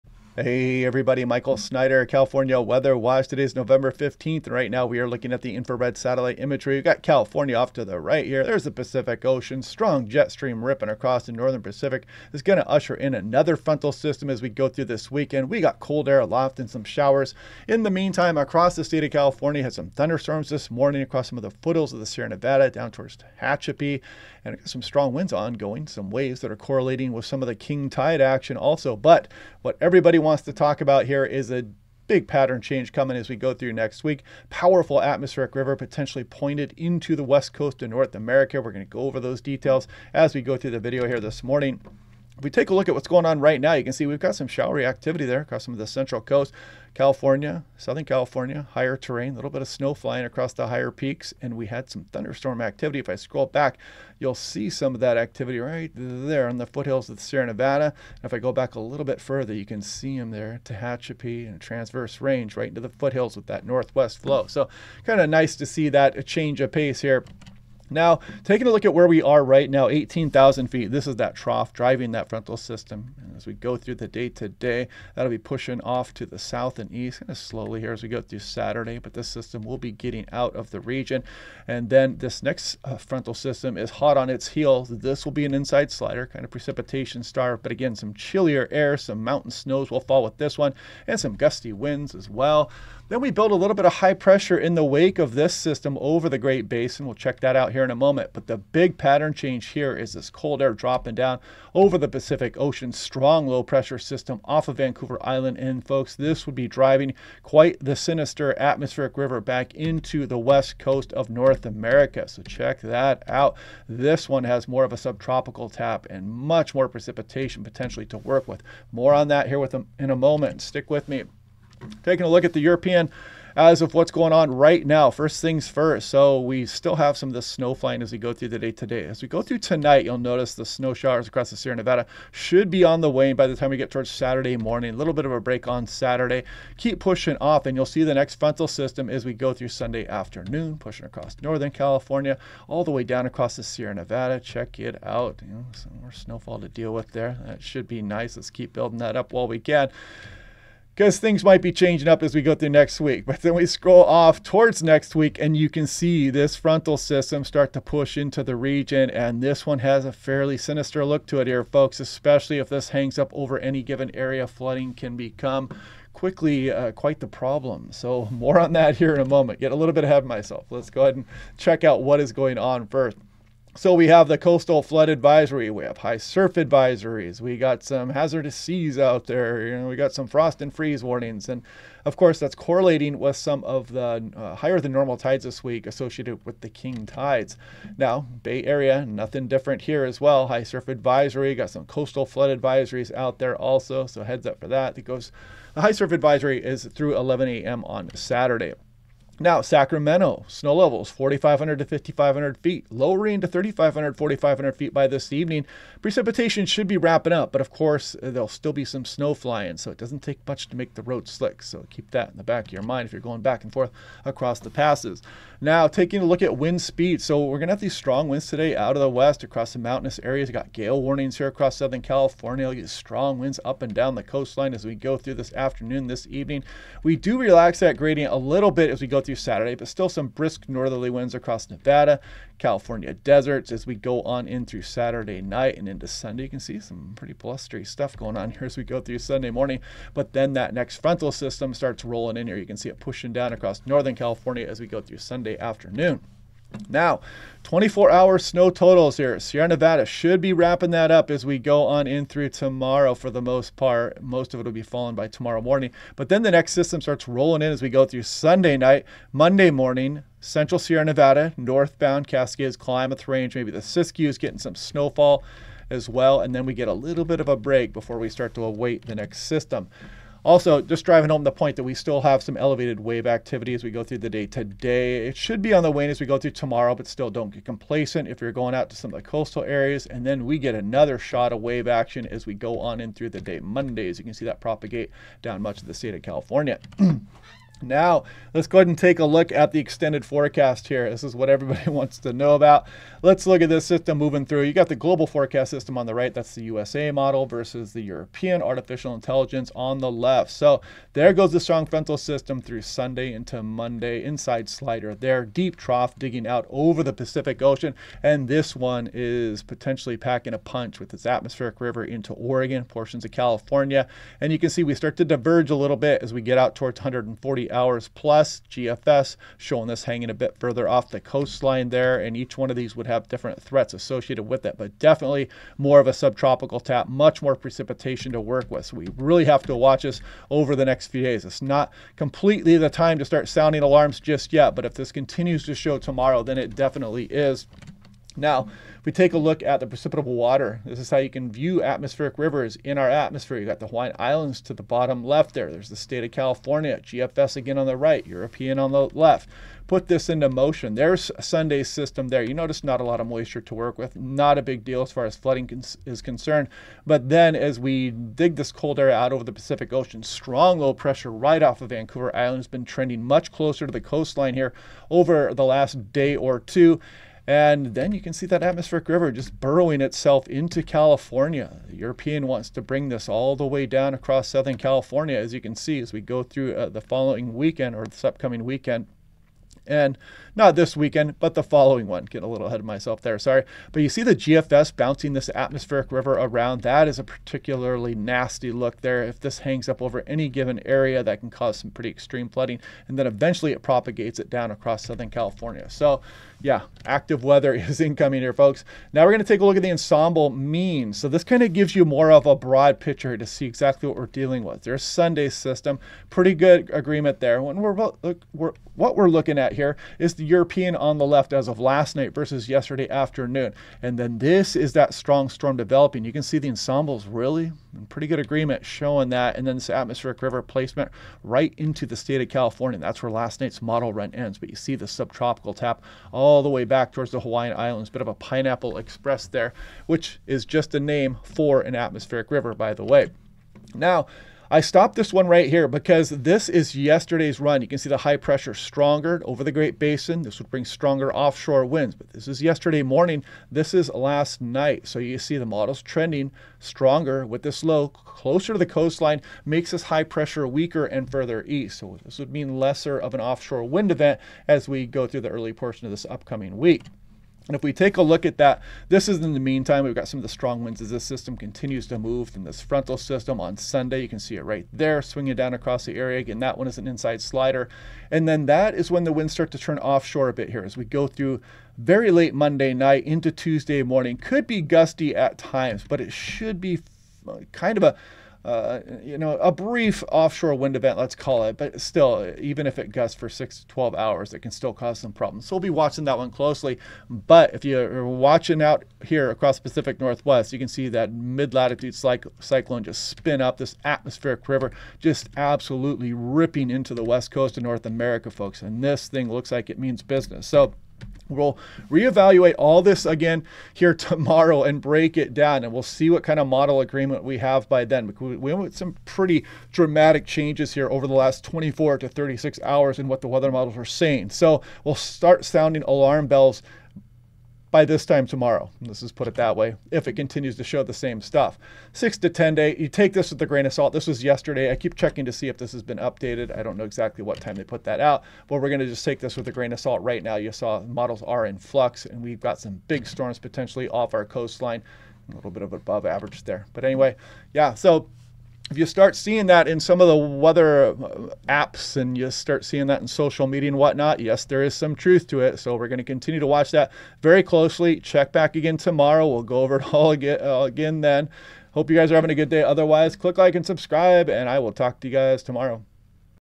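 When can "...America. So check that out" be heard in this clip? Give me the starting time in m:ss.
1:51.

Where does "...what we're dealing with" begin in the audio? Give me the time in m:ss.
6:44.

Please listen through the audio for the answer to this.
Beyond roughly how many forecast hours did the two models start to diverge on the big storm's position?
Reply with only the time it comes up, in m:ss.
5:16.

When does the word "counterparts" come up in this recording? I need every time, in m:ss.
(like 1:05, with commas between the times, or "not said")
not said.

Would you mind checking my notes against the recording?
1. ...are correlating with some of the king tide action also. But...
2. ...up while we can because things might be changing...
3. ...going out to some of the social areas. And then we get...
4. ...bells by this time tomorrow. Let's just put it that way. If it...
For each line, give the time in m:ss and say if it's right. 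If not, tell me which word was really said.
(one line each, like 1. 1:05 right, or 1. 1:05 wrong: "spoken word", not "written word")
1. 0:26 right
2. 2:29 right
3. 4:38 wrong: "coastal", not "social"
4. 8:36 right.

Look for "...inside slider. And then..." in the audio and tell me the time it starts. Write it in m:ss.
7:47.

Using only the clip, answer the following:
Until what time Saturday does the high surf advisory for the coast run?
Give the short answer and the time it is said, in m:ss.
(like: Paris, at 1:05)
11 a.m., at 3:17.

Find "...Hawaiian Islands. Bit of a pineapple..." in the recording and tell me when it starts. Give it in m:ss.
7:07.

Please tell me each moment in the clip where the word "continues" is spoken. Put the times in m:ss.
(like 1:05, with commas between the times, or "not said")
5:35, 7:41, 8:40, 9:06.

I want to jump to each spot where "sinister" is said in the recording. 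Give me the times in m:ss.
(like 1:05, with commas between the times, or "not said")
1:47, 2:40.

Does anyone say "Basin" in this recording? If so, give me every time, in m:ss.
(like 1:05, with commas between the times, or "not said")
1:36, 7:19.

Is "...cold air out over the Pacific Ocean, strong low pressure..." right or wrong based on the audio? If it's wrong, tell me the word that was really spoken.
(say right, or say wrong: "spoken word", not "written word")
right.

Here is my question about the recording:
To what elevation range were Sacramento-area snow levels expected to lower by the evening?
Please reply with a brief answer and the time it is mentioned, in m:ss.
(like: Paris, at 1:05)
3,500 to 4,500 feet, at 3:23.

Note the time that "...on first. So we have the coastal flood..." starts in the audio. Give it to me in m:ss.
2:52.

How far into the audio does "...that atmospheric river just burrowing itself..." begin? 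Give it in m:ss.
6:08.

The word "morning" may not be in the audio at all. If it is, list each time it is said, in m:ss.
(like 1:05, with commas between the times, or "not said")
0:20, 0:41, 2:14, 3:59, 4:15, 4:19, 7:23, 7:54.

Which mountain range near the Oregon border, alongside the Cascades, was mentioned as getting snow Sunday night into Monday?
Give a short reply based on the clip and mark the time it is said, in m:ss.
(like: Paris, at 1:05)
Klamath Range, at 4:22.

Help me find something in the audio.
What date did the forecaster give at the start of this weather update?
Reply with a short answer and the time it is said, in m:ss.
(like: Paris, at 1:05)
November 15th, at 0:03.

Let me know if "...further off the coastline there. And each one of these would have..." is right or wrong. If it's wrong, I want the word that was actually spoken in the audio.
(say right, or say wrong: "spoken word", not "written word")
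right.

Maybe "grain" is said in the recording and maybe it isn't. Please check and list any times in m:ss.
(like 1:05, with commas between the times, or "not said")
8:43, 8:49.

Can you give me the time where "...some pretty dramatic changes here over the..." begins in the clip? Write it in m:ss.
8:28.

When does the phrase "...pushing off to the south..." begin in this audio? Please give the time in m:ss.
1:15.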